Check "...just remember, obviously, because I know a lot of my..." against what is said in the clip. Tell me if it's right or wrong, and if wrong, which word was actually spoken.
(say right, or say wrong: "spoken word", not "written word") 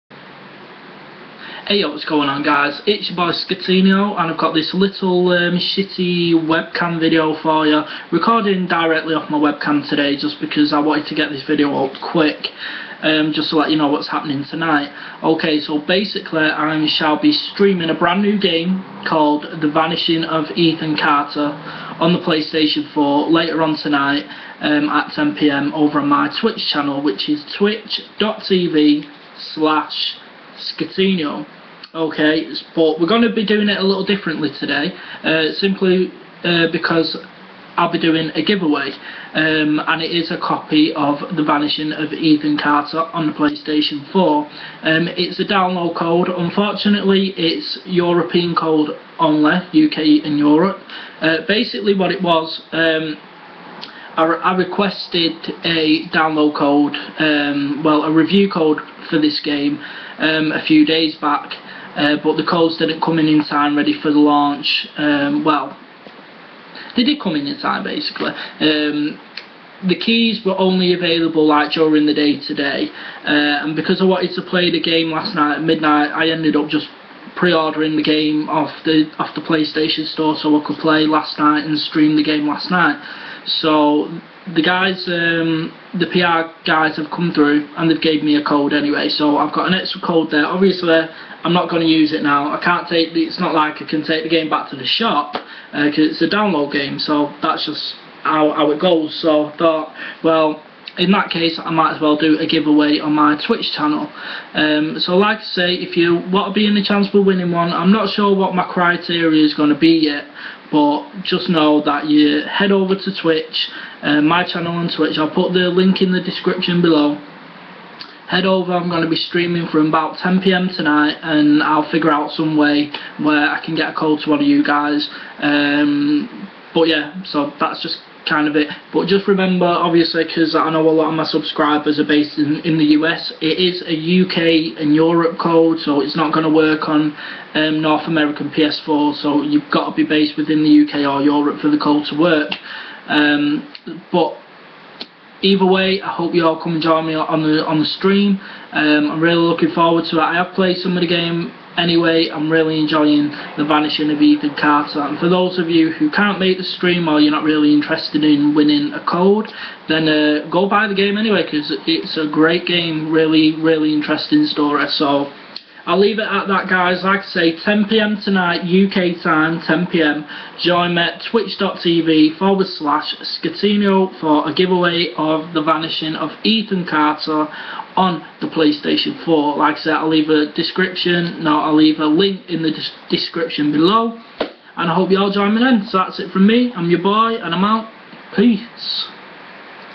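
right.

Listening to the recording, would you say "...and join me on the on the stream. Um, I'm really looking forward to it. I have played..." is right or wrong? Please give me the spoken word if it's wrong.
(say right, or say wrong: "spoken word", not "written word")
right.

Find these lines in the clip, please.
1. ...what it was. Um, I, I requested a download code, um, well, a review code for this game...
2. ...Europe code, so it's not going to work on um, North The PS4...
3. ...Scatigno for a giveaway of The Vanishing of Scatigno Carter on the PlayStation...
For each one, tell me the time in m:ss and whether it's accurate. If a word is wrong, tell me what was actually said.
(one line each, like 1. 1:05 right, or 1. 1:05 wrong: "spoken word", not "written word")
1. 0:51 right
2. 2:14 wrong: "American", not "The"
3. 2:53 wrong: "Ethan", not "Scatigno".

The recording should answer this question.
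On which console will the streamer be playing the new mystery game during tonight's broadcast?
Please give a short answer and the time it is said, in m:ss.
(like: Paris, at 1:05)
PlayStation 4, at 0:22.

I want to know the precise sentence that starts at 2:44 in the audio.
So I'll leave it at that, guys.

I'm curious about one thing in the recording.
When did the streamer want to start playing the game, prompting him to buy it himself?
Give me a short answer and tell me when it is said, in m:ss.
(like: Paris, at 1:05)
midnight, at 1:15.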